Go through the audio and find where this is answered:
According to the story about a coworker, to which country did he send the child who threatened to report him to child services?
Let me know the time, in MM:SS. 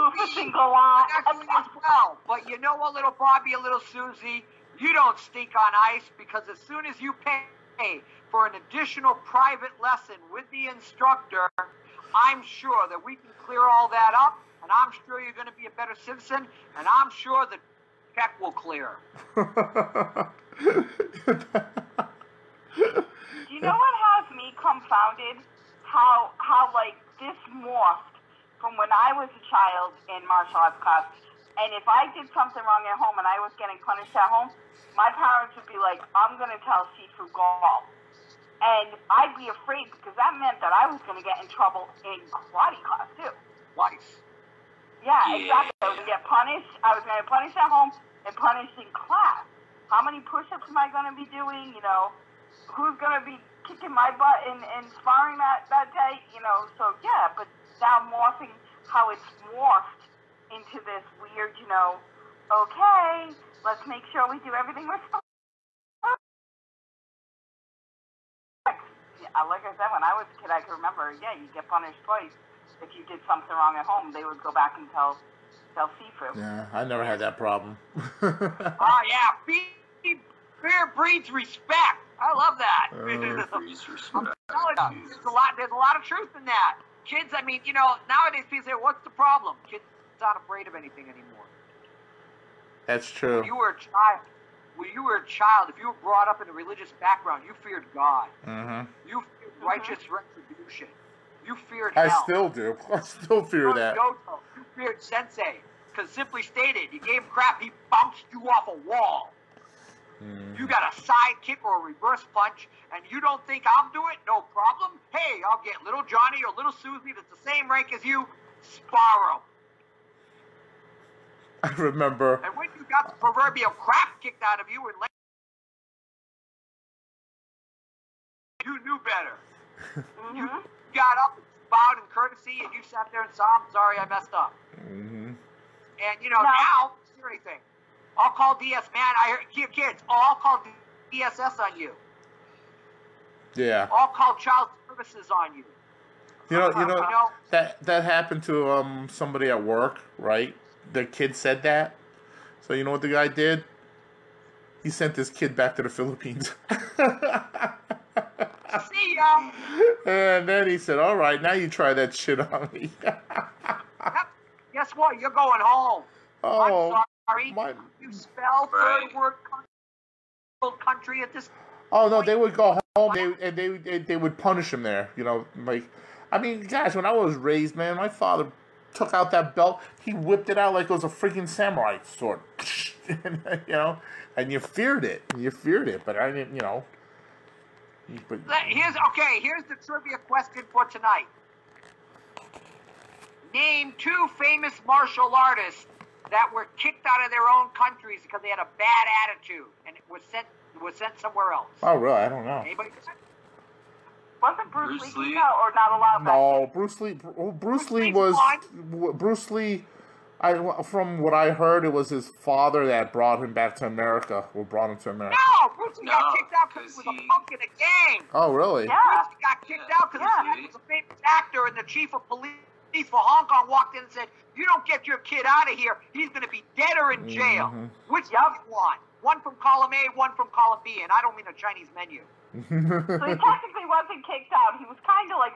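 02:35.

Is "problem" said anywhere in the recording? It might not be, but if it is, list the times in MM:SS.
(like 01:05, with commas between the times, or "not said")
01:17, 01:29, 01:54.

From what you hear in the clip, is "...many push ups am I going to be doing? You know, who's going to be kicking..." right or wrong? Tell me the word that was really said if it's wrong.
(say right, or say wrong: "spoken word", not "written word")
right.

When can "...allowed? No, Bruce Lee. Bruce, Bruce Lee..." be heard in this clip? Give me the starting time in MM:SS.
03:25.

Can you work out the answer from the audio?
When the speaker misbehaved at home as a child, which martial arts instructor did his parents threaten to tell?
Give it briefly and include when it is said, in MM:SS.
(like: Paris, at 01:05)
Sifu Gall, at 00:36.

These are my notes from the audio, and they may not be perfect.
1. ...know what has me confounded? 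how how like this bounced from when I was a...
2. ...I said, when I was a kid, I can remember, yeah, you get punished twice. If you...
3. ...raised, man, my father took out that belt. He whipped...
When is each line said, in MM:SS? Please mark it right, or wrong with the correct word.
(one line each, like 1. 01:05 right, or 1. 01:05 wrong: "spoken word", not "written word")
1. 00:23 wrong: "morphed", not "bounced"
2. 01:09 right
3. 02:57 right.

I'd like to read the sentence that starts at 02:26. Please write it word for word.
You know, you know, that that happened to um somebody at work, right?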